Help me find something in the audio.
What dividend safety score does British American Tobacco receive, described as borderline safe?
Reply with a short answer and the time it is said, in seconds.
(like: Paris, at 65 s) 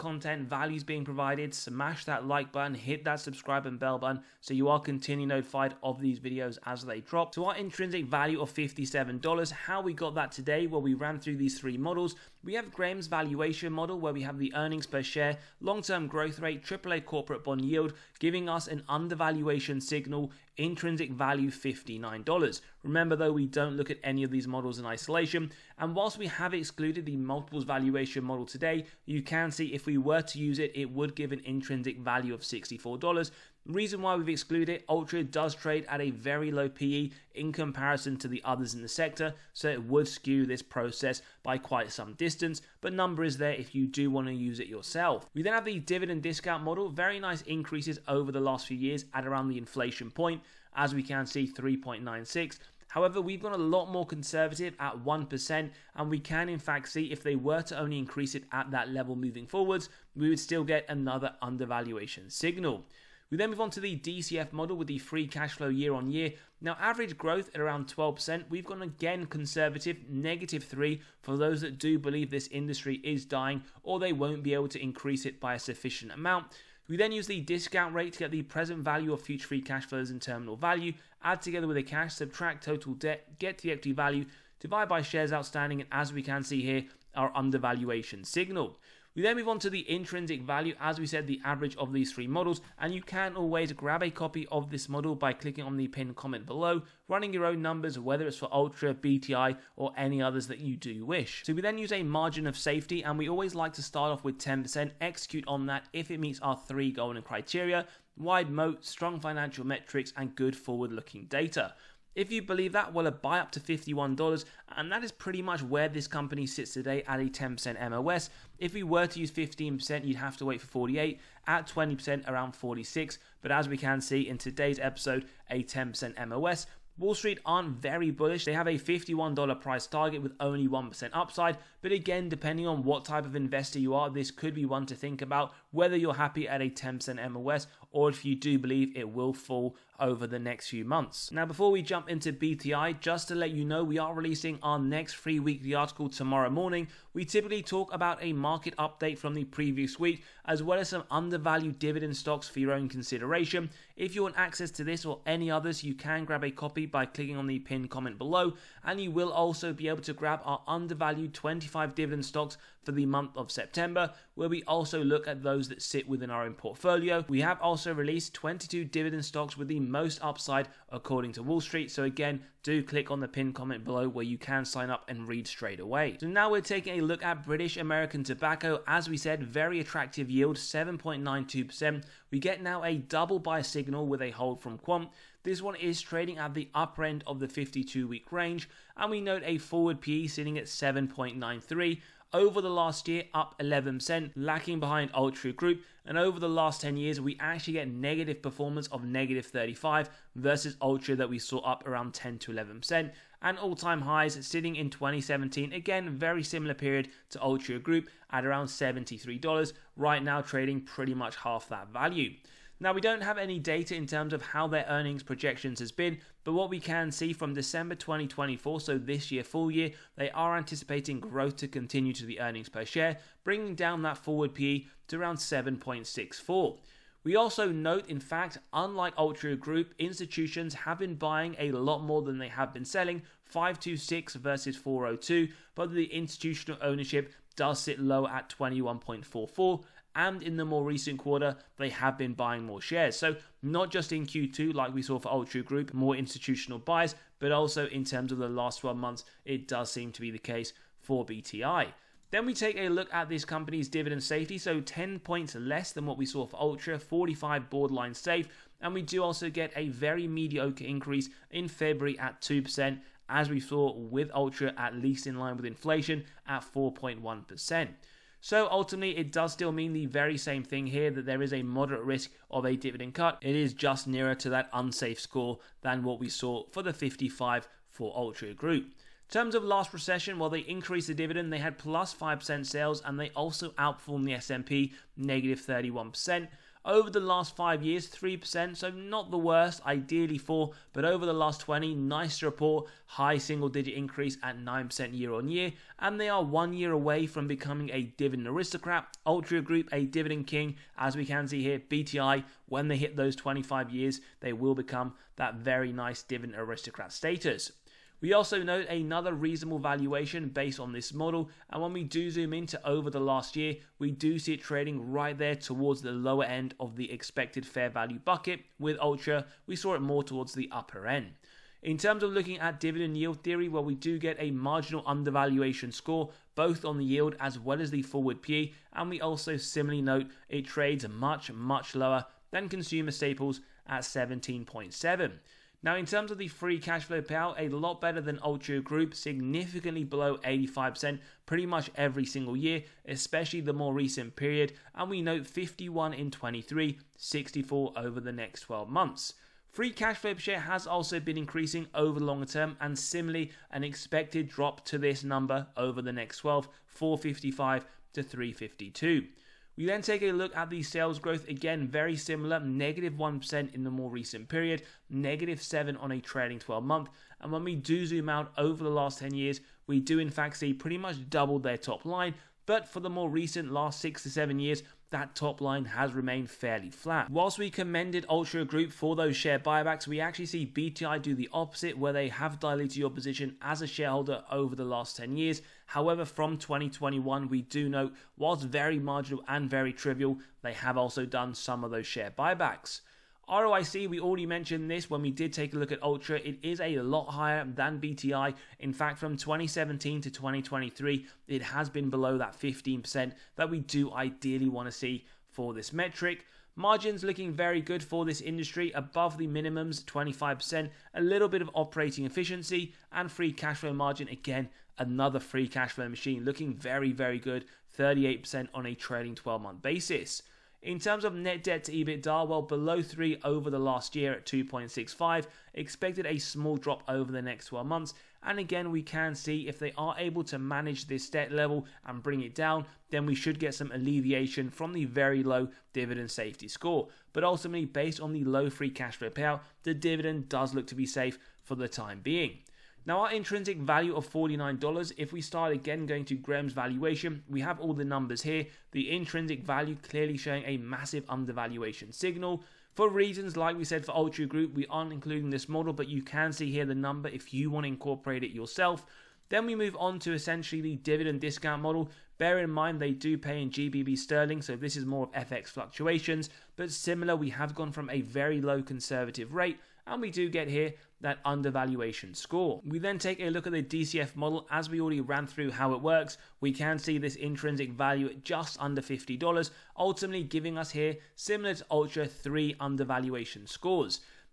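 45, at 256 s.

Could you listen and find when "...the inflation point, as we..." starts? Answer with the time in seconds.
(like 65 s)
49 s.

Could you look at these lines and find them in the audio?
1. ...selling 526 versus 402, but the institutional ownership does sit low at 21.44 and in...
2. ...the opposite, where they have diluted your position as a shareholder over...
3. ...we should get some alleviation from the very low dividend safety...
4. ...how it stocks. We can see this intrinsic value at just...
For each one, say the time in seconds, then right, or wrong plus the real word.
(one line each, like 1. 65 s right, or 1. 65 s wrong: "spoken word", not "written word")
1. 232 s right
2. 381 s right
3. 433 s right
4. 475 s wrong: "works", not "stocks".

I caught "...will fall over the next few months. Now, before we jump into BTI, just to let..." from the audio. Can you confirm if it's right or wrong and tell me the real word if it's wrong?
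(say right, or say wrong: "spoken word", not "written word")
right.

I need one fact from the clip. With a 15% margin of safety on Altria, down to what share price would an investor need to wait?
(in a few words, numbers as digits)
$48.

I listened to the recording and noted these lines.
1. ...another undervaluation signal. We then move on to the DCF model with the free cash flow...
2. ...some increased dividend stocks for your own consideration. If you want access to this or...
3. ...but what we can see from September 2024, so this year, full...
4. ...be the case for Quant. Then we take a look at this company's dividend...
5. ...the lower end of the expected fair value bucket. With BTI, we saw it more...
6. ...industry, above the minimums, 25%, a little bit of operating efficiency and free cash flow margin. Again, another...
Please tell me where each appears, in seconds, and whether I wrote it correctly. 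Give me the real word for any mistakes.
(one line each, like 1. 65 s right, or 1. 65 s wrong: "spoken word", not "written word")
1. 60 s right
2. 150 s wrong: "undervalued", not "increased"
3. 216 s wrong: "December", not "September"
4. 250 s wrong: "BTI", not "Quant"
5. 316 s wrong: "Altria", not "BTI"
6. 408 s right.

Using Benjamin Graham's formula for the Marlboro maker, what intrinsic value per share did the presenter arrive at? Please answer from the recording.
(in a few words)
$59.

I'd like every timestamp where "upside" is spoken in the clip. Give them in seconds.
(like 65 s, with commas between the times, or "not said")
131 s, 170 s.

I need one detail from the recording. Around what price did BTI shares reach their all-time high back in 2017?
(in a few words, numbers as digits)
$73.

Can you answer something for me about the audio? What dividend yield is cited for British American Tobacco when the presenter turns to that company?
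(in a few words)
7.92%.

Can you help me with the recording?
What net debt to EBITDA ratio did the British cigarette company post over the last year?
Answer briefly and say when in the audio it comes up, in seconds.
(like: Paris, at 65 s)
2.65, at 424 s.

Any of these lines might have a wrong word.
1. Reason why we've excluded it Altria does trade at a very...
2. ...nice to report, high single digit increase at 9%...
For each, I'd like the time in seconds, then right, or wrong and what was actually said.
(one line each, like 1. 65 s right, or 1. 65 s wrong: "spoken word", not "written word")
1. 33 s right
2. 291 s right.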